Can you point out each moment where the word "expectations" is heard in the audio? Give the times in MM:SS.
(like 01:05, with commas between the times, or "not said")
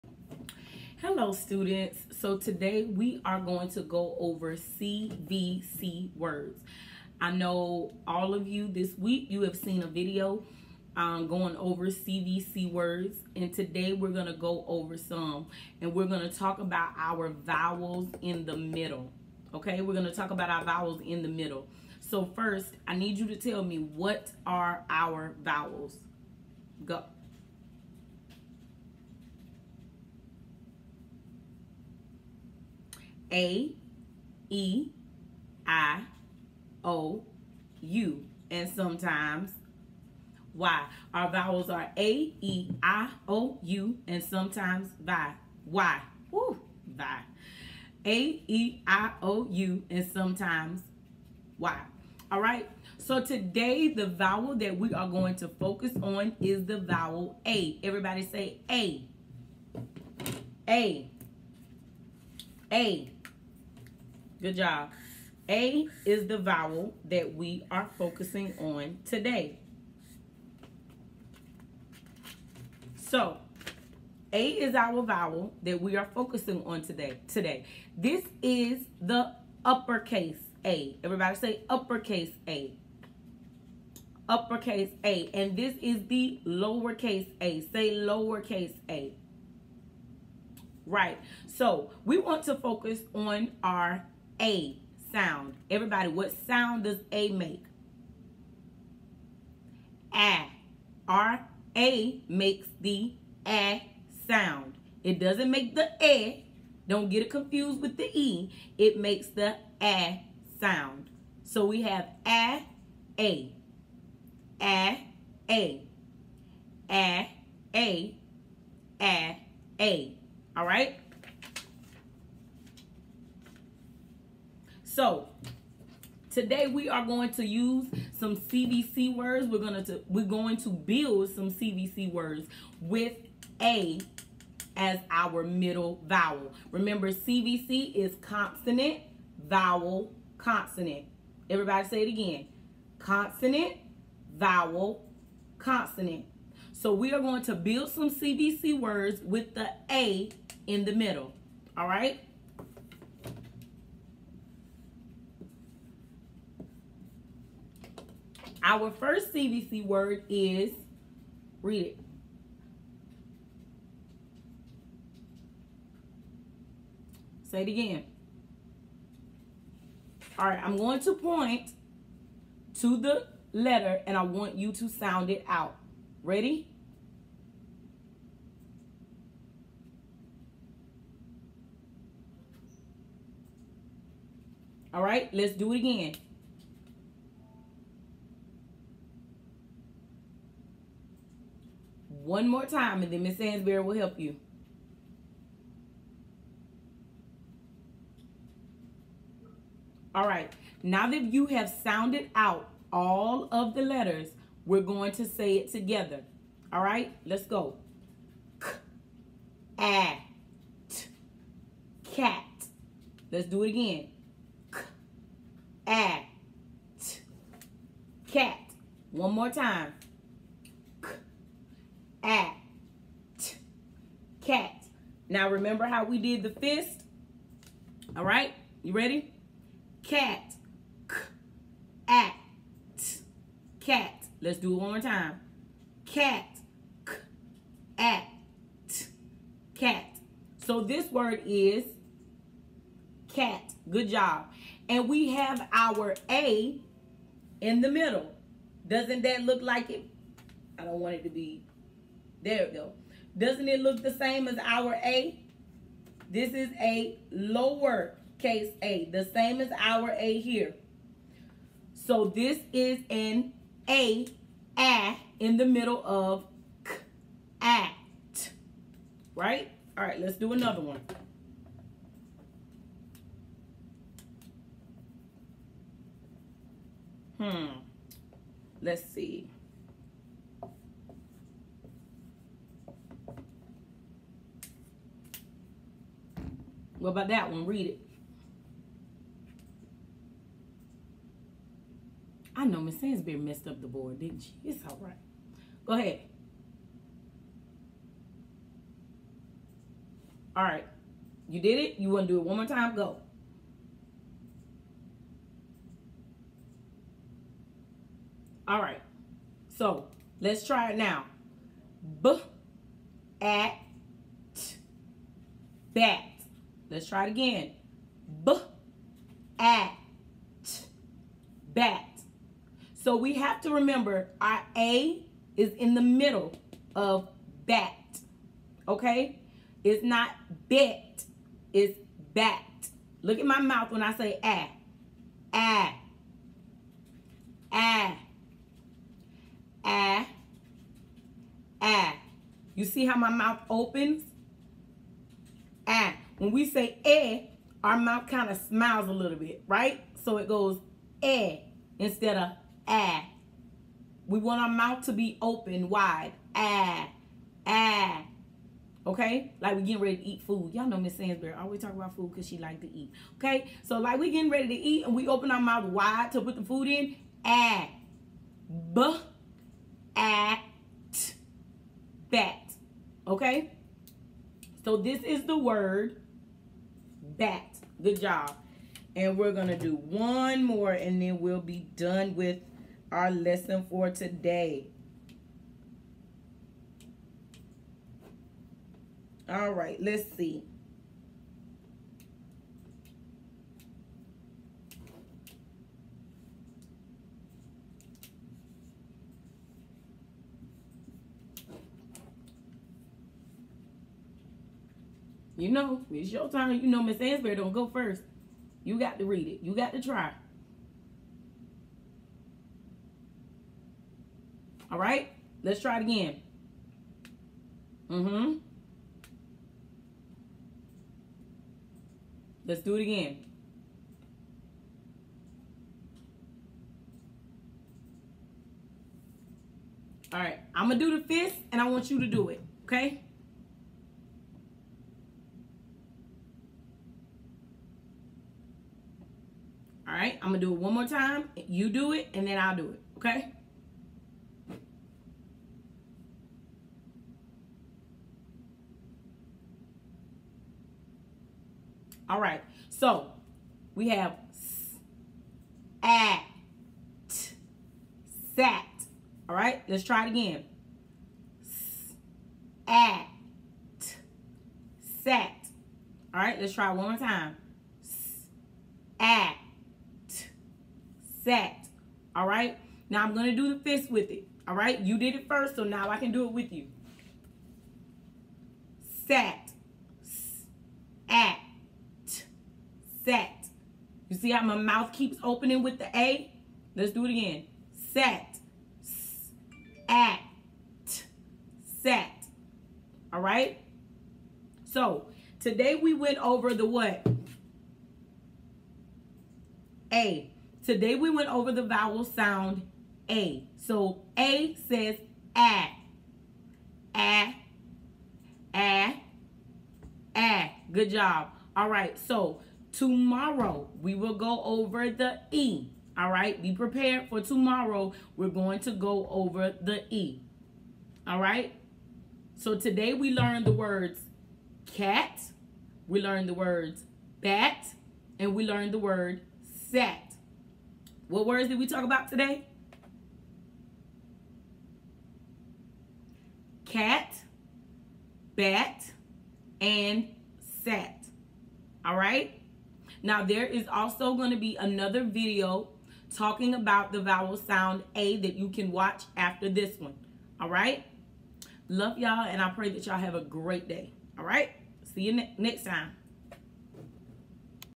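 not said.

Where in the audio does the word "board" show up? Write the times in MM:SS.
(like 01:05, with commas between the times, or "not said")
04:53.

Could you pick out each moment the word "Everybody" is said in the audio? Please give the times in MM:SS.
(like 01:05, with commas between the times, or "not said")
00:57, 01:21, 01:35, 02:21.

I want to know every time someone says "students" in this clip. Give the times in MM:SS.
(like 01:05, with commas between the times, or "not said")
00:01.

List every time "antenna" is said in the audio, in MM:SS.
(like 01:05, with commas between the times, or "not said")
not said.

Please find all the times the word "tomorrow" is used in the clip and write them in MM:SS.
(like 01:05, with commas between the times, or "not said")
08:32, 08:37.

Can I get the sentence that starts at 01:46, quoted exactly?
Don't get it confused with the E.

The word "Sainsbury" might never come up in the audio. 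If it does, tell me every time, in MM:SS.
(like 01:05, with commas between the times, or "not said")
04:53.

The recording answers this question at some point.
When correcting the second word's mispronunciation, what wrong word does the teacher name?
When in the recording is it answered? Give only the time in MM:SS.
05:29.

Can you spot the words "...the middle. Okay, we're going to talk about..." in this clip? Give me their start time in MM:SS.
00:18.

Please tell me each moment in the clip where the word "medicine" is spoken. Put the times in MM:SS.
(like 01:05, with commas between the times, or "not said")
not said.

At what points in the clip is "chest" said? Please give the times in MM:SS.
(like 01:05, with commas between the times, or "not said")
not said.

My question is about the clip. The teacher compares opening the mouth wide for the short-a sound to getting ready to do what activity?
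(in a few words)
Eat food.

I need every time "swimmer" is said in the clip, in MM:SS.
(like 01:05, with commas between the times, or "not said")
not said.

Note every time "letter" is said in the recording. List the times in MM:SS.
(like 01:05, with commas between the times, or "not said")
02:53, 03:23.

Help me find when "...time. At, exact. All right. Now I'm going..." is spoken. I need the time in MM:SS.
07:47.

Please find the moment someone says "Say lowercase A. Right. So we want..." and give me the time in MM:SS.
01:27.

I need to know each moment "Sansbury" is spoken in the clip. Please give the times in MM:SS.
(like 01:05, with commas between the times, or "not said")
03:13, 06:01, 06:47.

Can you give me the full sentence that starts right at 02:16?
Remember CVC is consonant, vowel, consonant.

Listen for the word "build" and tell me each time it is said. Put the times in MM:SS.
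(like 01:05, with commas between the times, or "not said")
02:10, 02:27.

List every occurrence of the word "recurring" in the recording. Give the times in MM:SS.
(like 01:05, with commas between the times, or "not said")
not said.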